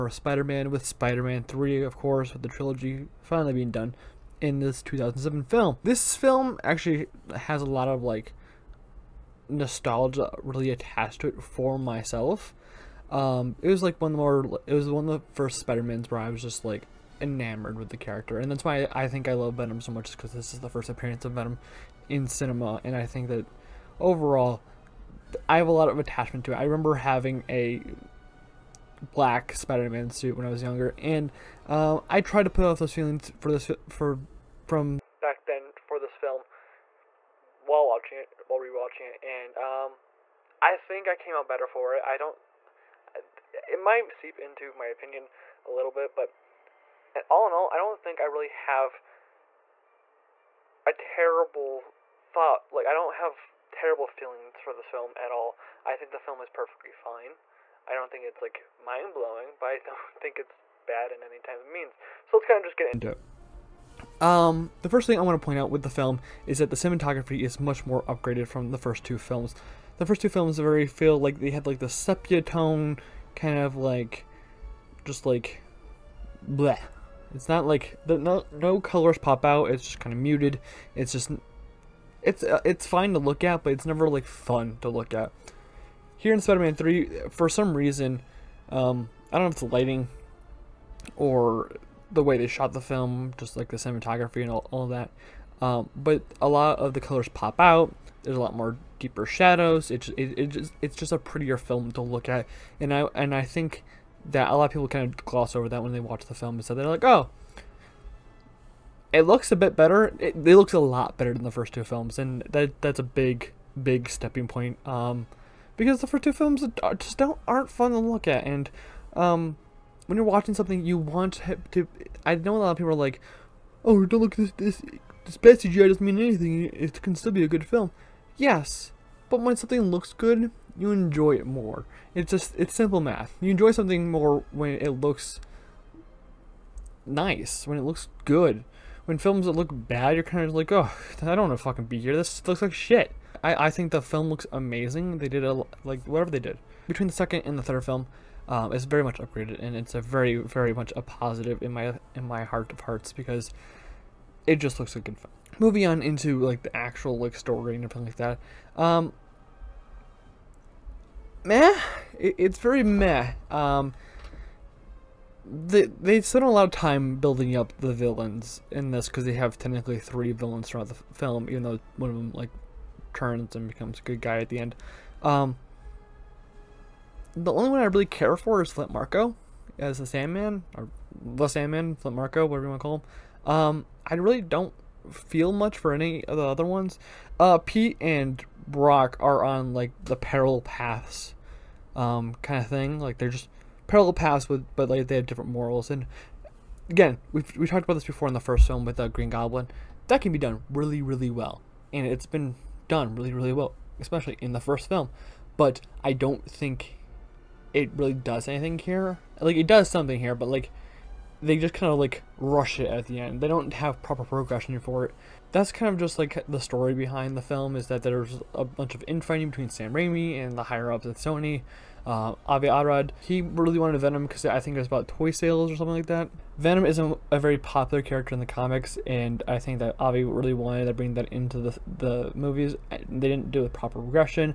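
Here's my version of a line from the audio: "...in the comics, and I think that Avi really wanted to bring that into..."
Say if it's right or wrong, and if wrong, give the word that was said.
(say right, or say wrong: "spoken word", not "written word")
right.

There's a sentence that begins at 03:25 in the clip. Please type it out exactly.
But I don't think it really does anything here.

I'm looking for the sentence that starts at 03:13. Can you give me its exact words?
Like they're just parallel paths with, but like they have different morals.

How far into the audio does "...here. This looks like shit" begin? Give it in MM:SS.
02:21.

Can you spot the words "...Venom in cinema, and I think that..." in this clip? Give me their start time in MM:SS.
00:21.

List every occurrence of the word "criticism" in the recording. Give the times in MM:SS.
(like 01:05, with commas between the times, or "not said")
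not said.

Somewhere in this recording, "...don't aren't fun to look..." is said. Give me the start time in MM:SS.
01:57.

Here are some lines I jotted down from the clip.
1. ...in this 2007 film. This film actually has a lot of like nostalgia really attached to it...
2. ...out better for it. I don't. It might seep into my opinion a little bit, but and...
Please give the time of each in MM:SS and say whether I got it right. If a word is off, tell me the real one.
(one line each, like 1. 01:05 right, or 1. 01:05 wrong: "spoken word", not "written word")
1. 00:04 right
2. 00:41 right.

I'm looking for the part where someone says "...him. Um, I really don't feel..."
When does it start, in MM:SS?
03:03.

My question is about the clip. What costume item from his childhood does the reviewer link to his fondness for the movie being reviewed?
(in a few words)
black Spider-Man suit.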